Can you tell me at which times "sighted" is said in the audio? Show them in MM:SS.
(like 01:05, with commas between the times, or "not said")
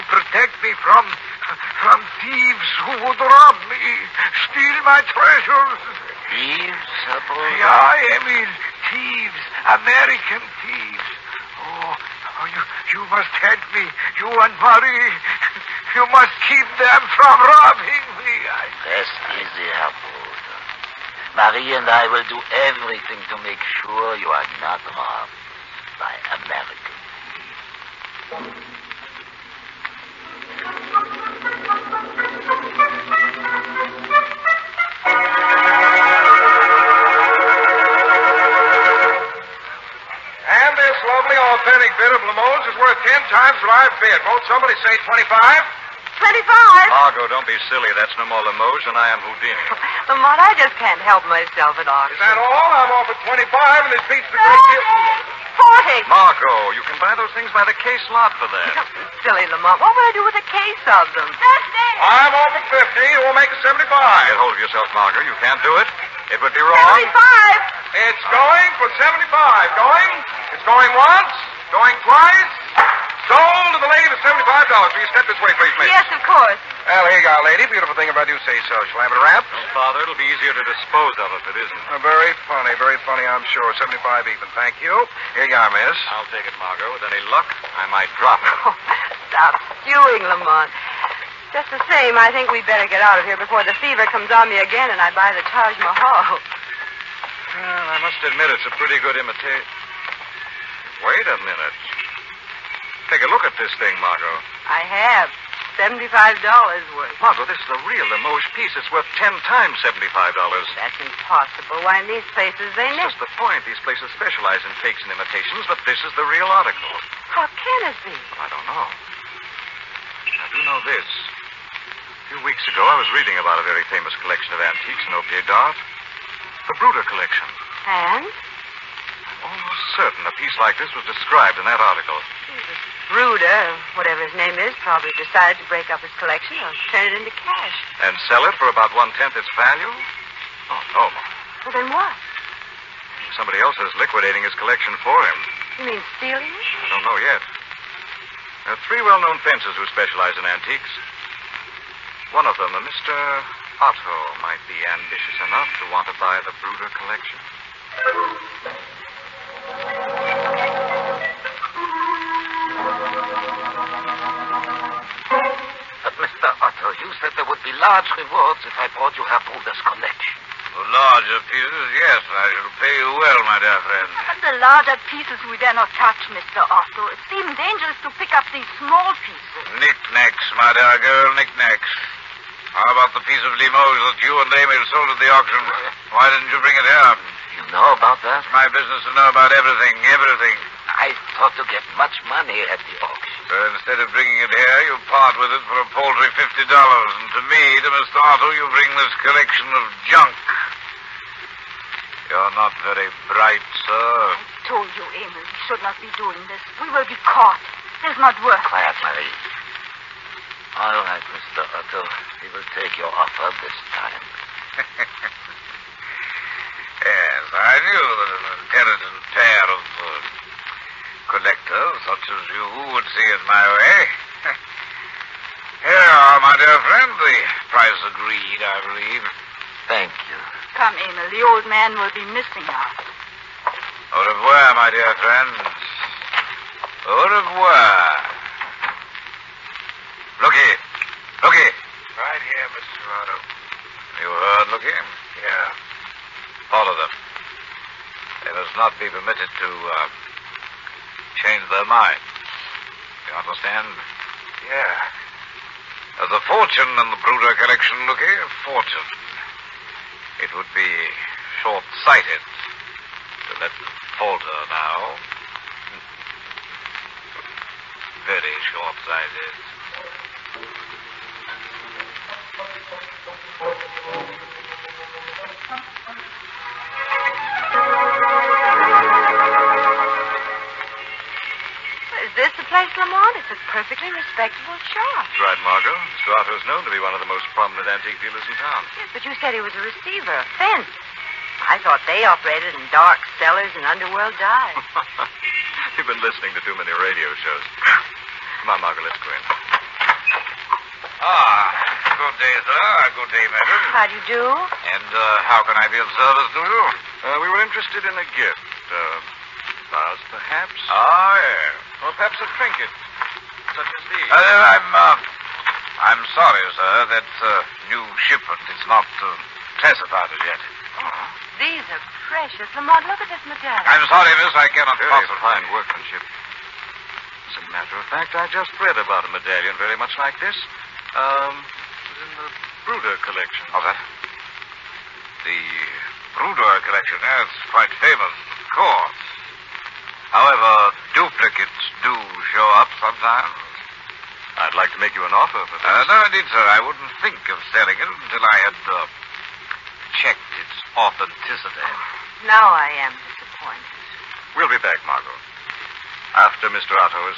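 04:21, 04:28.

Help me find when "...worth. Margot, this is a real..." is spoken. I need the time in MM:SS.
01:46.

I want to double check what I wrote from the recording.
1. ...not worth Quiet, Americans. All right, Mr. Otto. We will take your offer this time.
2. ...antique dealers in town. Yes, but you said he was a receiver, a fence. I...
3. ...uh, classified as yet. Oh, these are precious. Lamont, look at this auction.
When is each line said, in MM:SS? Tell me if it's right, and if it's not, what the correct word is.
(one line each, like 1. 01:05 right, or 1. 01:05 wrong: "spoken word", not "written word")
1. 03:28 wrong: "Marie", not "Americans"
2. 04:47 right
3. 05:19 wrong: "medallion", not "auction".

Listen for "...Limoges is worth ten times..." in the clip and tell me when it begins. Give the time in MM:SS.
00:42.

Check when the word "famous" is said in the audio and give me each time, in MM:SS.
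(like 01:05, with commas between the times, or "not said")
02:03, 05:38.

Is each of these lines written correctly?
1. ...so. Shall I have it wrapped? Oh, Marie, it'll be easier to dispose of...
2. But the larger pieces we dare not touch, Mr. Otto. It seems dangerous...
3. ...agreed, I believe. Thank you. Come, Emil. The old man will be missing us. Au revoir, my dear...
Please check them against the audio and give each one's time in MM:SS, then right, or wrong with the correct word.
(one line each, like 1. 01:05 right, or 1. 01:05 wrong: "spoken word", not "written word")
1. 01:18 wrong: "Father", not "Marie"
2. 02:54 right
3. 03:48 right.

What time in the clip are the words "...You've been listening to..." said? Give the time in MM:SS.
04:55.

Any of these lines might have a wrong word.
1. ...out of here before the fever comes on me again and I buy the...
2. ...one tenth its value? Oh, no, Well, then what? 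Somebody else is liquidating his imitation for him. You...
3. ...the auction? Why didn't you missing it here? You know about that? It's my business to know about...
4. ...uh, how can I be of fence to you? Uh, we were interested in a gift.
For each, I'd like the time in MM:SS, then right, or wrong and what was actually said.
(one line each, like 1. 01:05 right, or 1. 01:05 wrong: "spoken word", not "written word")
1. 01:33 right
2. 02:18 wrong: "collection", not "imitation"
3. 03:05 wrong: "bring", not "missing"
4. 05:05 wrong: "service", not "fence".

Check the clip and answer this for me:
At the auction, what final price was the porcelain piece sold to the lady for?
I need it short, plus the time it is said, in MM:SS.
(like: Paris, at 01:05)
$75, at 01:13.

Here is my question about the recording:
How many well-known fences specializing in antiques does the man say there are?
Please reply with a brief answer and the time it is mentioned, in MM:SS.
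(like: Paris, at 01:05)
3, at 02:28.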